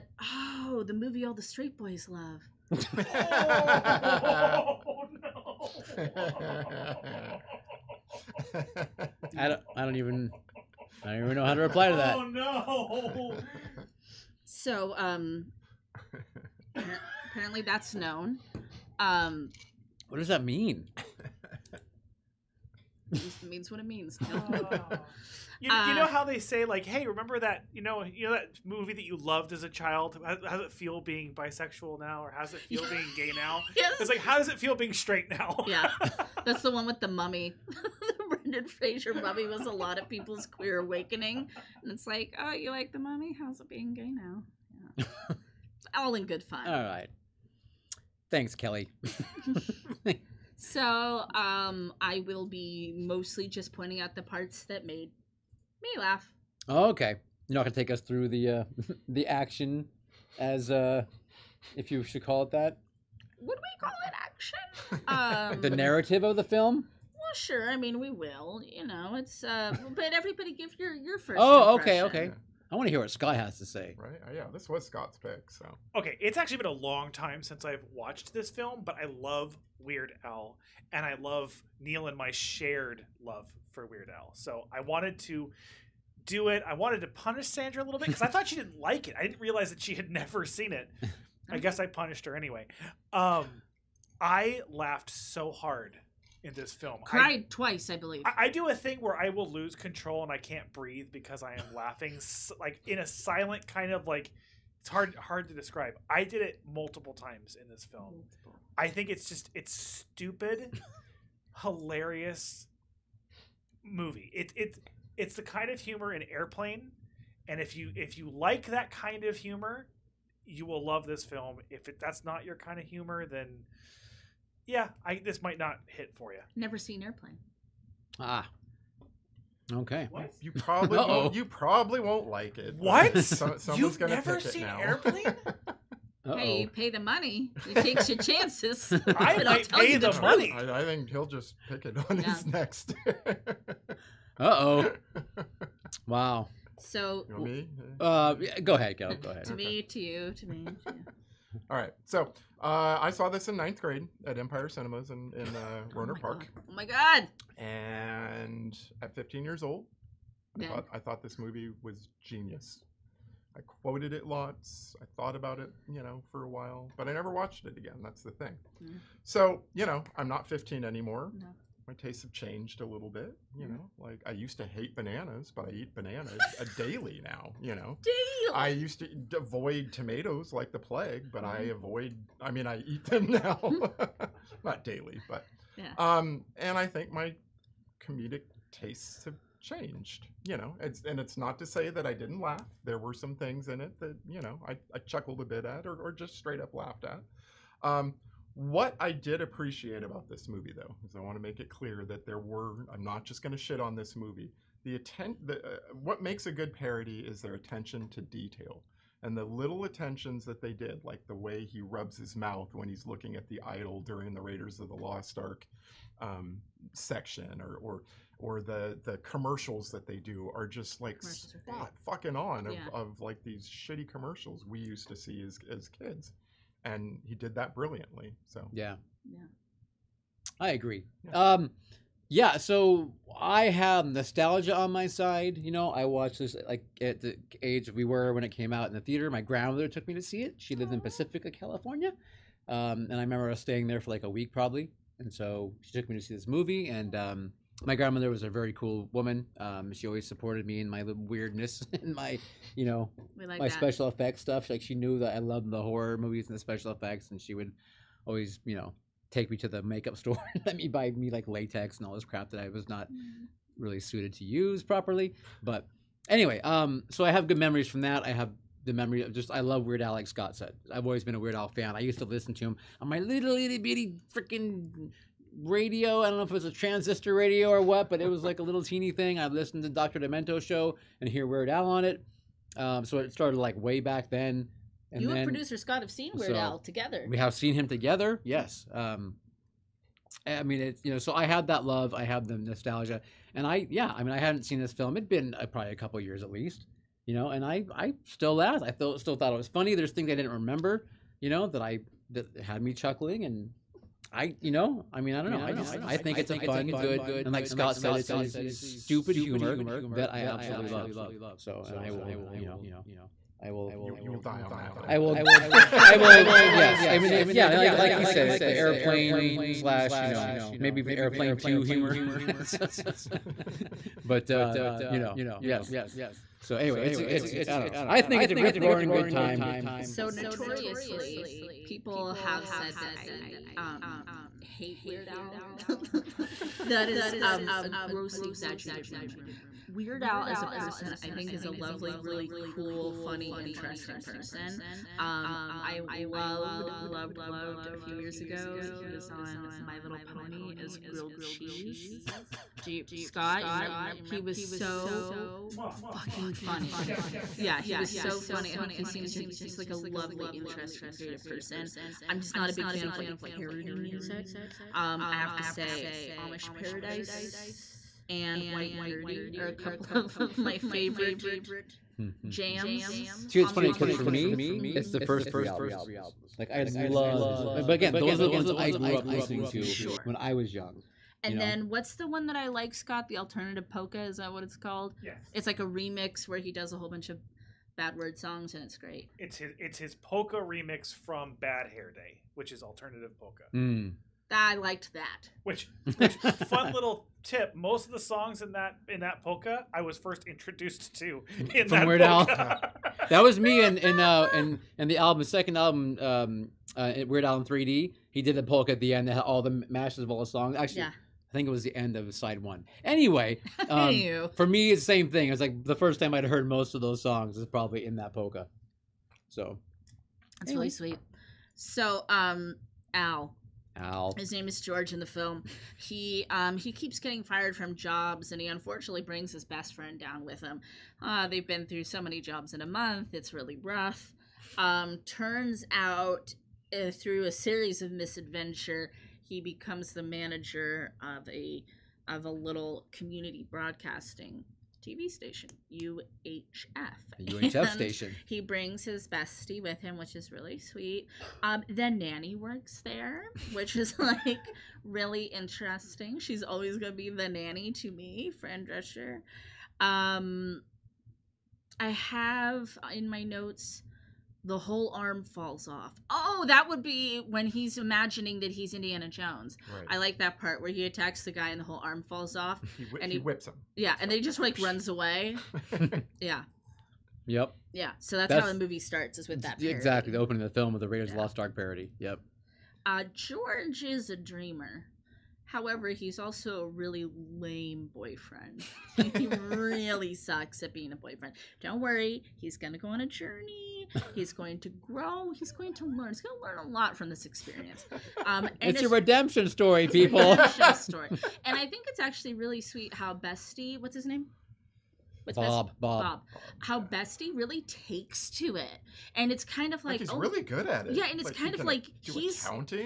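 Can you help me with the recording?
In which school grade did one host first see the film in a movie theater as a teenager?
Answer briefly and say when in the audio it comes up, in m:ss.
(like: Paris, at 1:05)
ninth grade, at 2:33.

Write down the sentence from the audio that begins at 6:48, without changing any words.
He did the polka at the end that had all the mashes of all the songs.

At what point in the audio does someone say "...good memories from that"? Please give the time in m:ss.
4:27.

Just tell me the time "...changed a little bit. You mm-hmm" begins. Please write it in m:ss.
2:52.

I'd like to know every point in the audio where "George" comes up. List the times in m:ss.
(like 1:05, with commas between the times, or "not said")
7:04, 8:03.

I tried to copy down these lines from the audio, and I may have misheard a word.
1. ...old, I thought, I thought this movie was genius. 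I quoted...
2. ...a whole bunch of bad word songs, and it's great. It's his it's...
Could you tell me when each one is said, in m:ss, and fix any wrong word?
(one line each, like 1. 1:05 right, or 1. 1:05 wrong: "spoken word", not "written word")
1. 2:39 right
2. 6:26 right.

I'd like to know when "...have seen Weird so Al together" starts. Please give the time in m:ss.
4:46.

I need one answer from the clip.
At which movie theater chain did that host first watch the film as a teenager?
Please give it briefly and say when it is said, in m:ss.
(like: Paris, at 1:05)
Empire Cinemas, at 2:34.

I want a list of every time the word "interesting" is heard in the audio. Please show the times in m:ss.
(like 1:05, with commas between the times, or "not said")
5:43, 6:00, 7:35.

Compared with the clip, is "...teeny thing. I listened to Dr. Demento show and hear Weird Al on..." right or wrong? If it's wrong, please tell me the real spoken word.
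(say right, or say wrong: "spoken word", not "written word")
right.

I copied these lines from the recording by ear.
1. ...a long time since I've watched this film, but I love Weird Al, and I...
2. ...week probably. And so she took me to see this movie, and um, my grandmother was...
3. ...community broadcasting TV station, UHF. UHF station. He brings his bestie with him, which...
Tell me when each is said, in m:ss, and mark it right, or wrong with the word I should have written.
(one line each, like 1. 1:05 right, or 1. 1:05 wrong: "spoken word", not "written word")
1. 1:16 right
2. 4:04 right
3. 7:23 right.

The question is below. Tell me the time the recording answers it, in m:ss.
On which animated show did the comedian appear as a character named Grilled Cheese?
5:49.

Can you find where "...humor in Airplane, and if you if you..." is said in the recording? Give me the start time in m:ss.
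1:55.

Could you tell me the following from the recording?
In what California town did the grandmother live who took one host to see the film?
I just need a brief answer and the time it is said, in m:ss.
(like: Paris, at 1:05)
Pacifica, at 4:00.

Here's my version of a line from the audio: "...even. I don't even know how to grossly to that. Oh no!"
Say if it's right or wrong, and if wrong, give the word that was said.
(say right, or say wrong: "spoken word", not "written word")
wrong: "reply", not "grossly".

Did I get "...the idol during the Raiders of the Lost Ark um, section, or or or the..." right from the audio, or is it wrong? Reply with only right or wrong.
right.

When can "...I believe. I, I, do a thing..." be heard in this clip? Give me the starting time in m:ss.
1:37.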